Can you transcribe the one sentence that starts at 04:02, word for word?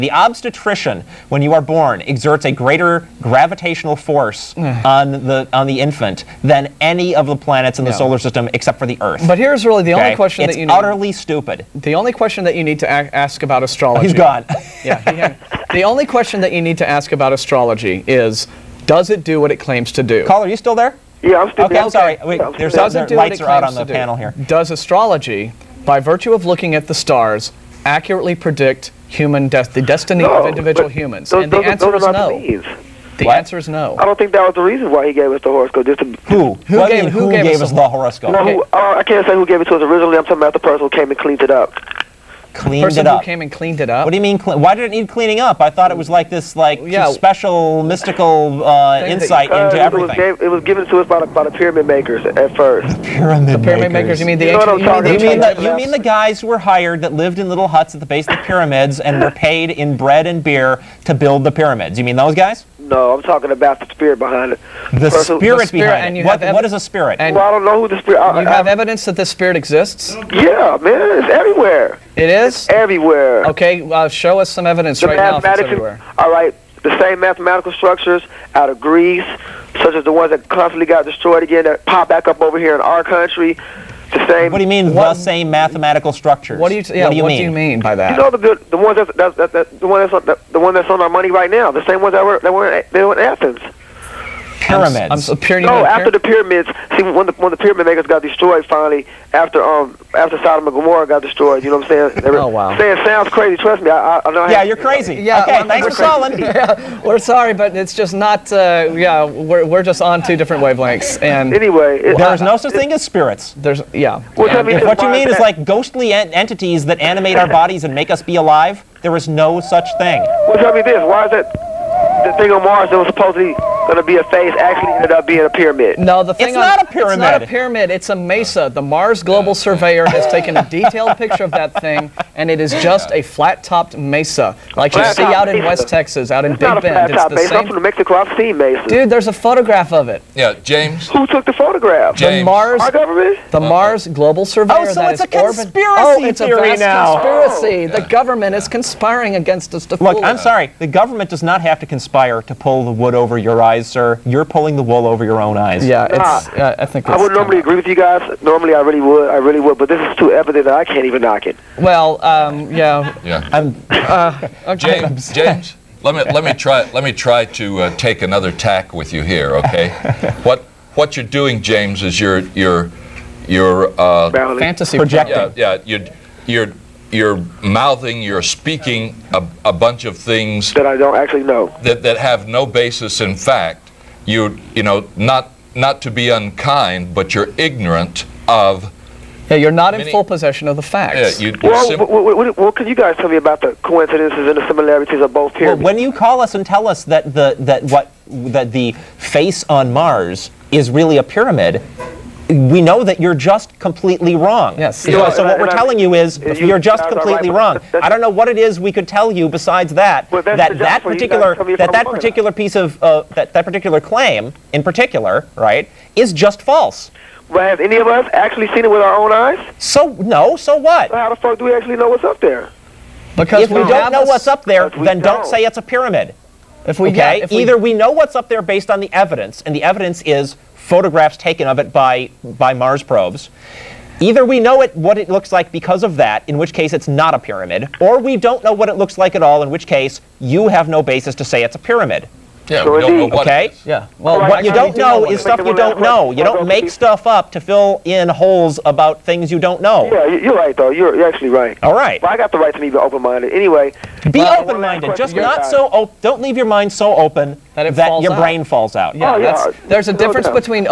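Yeah, we don't know what okay?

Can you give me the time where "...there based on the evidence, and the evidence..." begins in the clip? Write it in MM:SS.
03:48.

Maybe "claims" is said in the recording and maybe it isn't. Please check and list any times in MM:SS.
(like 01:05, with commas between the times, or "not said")
00:19, 03:33.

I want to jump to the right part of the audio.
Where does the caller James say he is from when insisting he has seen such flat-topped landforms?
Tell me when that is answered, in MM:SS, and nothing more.
02:17.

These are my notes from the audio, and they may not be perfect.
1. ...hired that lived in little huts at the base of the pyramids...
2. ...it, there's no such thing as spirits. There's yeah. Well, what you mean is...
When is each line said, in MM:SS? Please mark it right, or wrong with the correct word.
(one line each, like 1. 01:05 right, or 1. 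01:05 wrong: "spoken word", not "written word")
1. 00:56 right
2. 01:51 right.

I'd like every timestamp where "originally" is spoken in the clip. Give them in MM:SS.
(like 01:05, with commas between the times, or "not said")
00:39.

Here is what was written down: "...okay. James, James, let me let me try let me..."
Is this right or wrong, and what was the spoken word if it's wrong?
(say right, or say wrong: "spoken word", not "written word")
right.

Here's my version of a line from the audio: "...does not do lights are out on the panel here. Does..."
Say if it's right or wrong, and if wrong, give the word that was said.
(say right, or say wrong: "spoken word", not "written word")
right.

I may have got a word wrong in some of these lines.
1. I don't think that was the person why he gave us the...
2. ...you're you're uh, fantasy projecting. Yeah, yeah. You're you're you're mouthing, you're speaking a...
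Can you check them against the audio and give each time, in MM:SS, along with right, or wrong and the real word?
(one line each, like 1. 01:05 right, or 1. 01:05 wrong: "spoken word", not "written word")
1. 00:33 wrong: "reason", not "person"
2. 02:52 right.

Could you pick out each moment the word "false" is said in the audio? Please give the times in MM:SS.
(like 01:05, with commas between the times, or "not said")
03:36.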